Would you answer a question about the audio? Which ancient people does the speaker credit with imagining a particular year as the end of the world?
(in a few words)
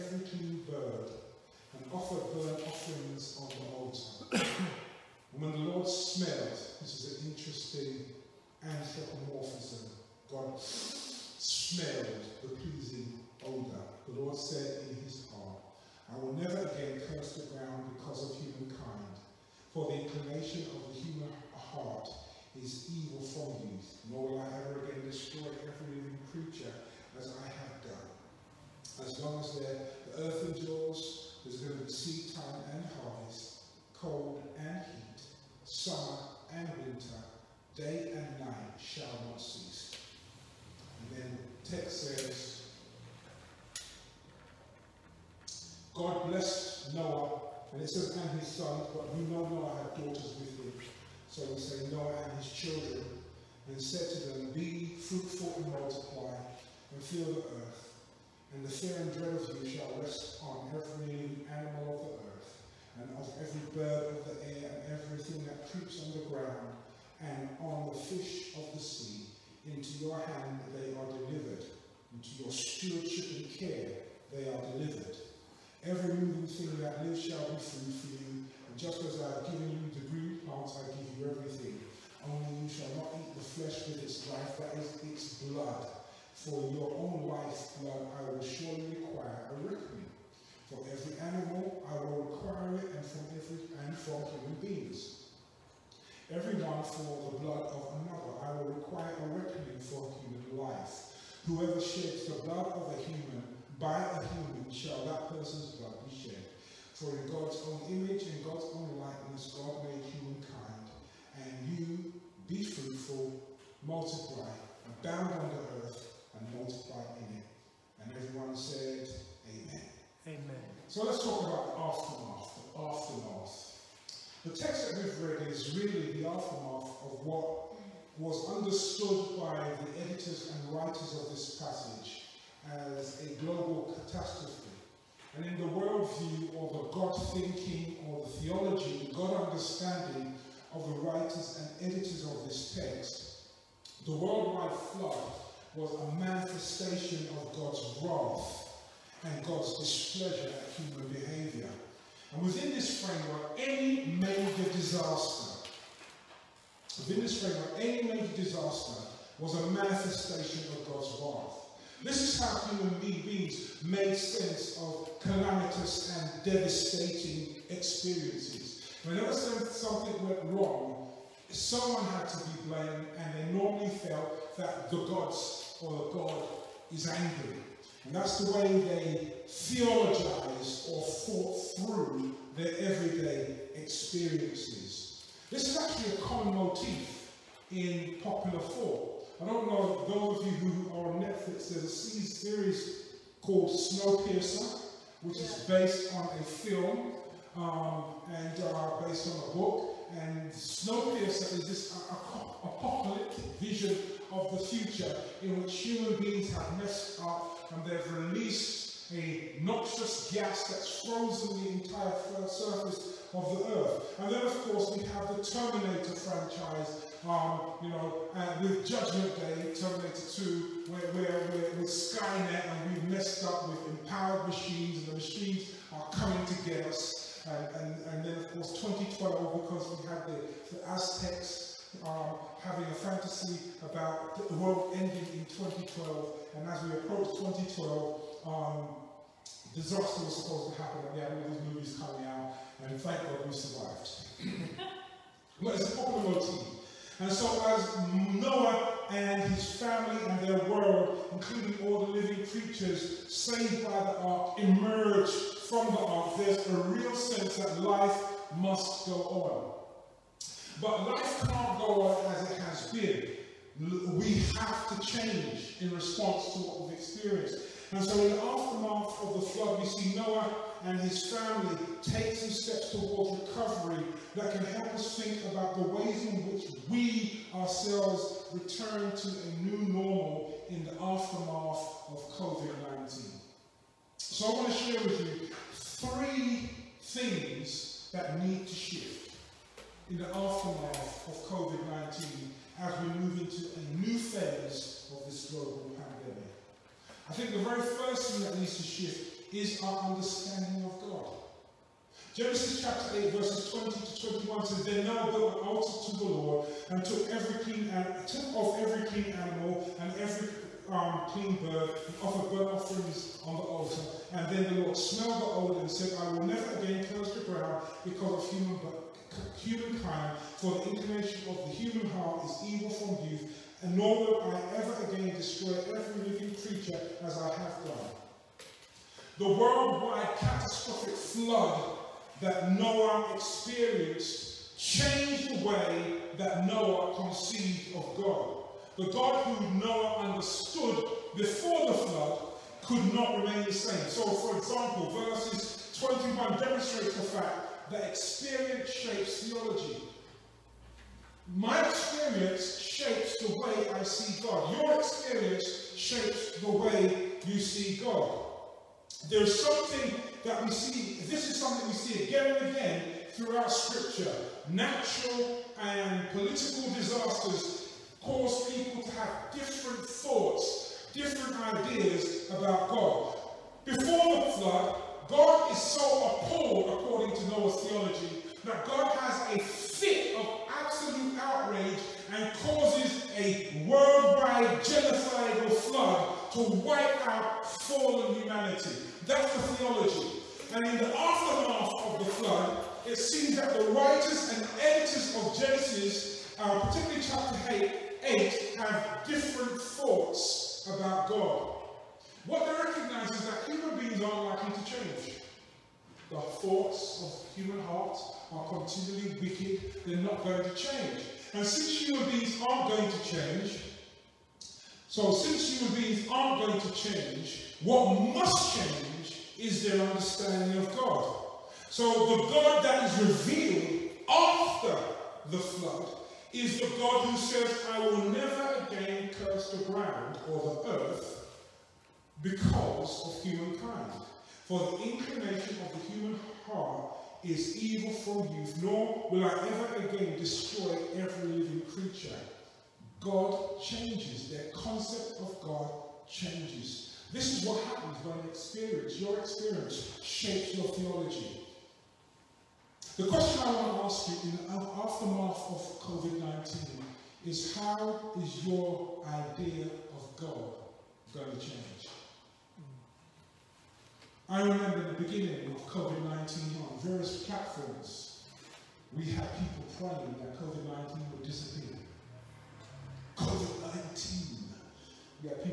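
The Aztecs.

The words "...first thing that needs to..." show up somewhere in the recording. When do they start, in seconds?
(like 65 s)
297 s.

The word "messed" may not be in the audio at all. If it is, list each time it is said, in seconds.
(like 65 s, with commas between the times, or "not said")
206 s, 223 s.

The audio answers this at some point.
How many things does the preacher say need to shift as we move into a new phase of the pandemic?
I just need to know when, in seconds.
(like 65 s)
285 s.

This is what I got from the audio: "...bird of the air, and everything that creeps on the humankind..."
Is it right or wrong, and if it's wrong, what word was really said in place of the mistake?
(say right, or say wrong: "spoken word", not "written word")
wrong: "ground", not "humankind".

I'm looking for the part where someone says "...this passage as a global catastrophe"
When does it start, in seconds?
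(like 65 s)
131 s.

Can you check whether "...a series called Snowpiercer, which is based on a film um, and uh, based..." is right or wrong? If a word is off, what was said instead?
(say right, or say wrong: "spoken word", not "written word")
right.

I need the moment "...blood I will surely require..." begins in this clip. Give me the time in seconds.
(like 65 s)
87 s.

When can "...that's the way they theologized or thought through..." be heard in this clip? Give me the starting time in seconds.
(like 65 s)
178 s.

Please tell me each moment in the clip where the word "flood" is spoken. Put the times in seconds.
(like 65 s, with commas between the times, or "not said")
144 s, 269 s, 331 s, 341 s, 374 s, 385 s, 392 s, 425 s.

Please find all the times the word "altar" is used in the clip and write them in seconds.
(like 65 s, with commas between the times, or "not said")
3 s, 305 s, 313 s.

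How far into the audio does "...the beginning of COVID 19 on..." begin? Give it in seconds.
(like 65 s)
465 s.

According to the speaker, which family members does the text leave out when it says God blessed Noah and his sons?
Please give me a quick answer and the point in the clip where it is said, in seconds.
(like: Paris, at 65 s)
Daughters, at 50 s.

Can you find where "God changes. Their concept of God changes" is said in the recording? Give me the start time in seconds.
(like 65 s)
443 s.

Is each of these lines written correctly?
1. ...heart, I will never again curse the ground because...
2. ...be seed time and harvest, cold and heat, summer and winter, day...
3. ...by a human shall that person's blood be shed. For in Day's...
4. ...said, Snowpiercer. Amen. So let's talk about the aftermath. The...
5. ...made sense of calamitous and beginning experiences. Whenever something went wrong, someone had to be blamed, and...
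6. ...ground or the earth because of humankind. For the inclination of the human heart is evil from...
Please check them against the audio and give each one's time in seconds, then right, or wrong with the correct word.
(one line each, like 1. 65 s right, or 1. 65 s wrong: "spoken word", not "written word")
1. 15 s right
2. 31 s right
3. 103 s wrong: "God", not "Day"
4. 118 s wrong: "Amen", not "Snowpiercer"
5. 163 s wrong: "devastating", not "beginning"
6. 429 s right.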